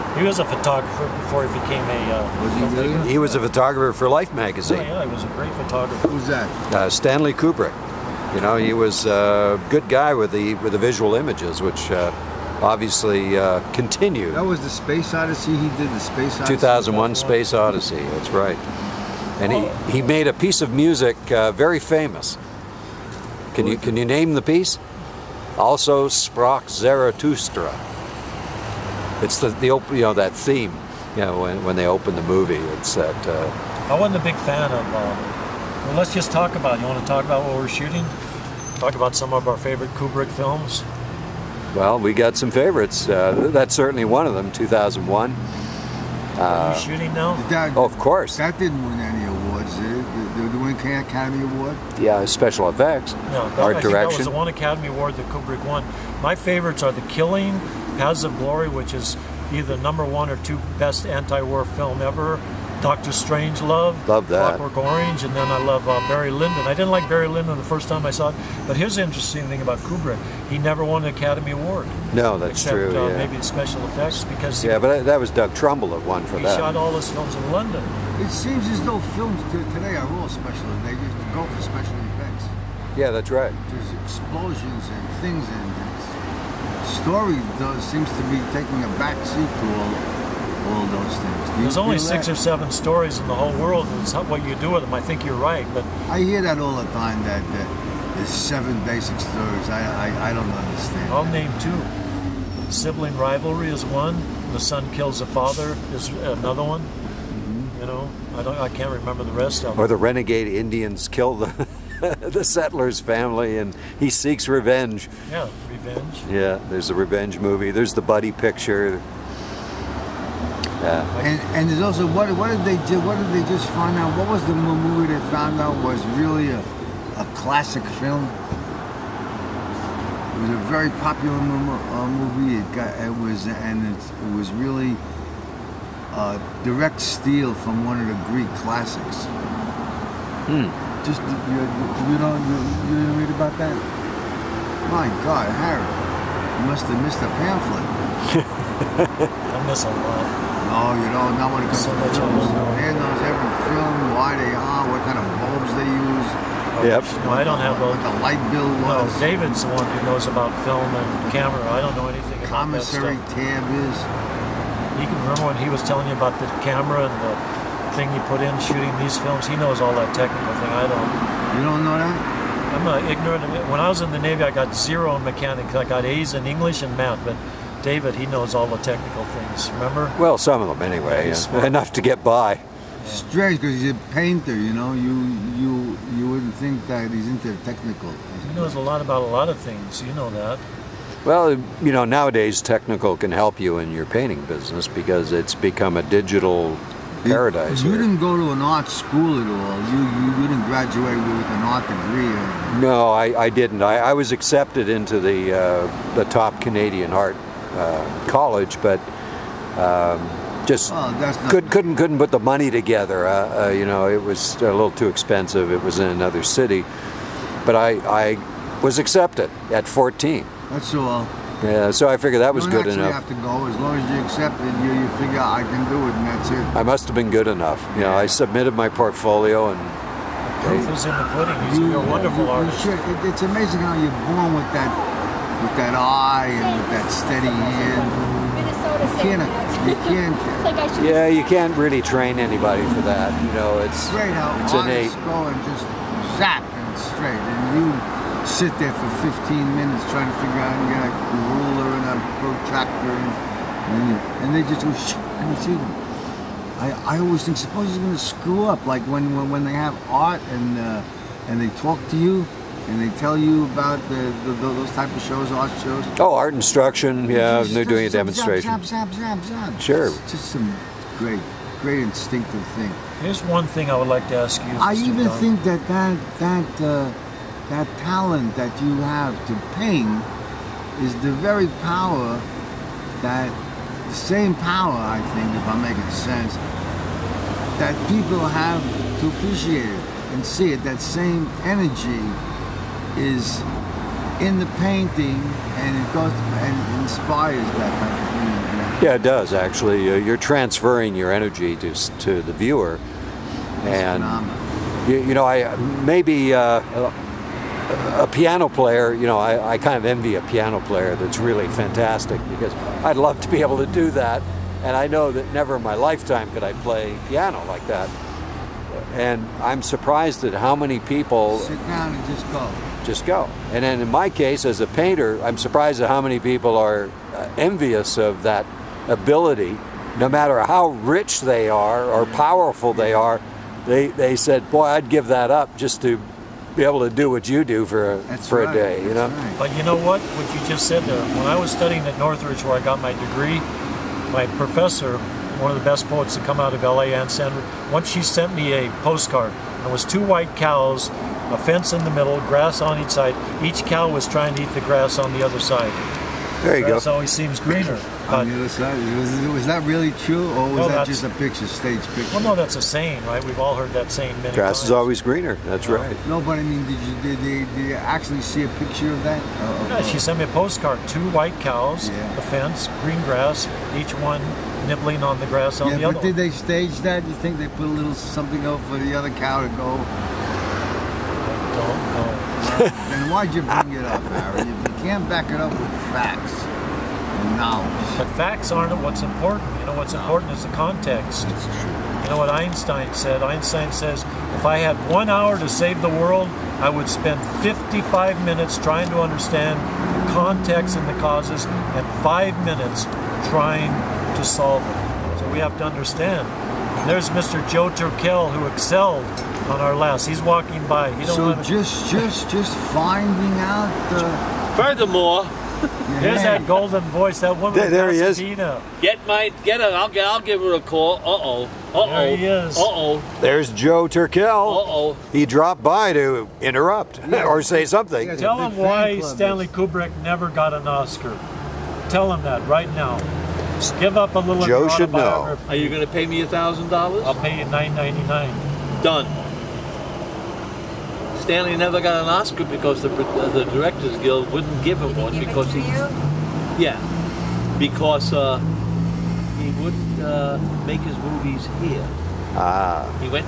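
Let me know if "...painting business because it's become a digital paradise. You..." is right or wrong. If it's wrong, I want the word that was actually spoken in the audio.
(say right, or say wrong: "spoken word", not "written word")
right.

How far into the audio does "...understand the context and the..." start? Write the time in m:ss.
6:39.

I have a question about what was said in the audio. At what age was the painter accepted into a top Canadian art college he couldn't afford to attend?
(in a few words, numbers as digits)
14.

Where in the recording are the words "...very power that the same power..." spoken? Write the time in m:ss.
4:41.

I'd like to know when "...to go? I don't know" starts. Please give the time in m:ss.
6:19.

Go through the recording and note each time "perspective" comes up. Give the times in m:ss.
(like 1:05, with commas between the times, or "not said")
not said.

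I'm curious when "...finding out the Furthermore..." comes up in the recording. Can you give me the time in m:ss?
6:52.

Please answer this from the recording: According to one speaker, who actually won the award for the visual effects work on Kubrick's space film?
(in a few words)
Doug Trumbull.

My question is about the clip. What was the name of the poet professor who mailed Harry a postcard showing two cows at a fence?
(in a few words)
Ann Stanford.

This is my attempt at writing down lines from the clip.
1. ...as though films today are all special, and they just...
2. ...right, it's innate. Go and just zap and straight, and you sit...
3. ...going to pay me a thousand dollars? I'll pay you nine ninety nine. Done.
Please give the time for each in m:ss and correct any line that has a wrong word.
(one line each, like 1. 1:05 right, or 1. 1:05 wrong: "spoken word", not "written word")
1. 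1:18 right
2. 4:04 right
3. 7:15 right.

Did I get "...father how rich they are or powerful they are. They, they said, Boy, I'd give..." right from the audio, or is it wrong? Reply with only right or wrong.
wrong.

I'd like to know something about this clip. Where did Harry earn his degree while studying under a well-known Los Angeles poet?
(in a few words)
Northridge.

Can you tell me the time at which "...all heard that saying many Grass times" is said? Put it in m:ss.
6:03.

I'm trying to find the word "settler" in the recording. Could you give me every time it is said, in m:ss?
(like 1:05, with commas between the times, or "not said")
1:52.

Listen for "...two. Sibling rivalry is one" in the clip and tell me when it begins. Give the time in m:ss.
1:41.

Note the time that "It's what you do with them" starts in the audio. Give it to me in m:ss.
1:34.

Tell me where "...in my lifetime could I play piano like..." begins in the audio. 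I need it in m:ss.
5:15.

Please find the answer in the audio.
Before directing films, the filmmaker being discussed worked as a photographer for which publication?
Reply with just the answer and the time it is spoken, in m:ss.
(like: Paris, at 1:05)
Life magazine, at 0:04.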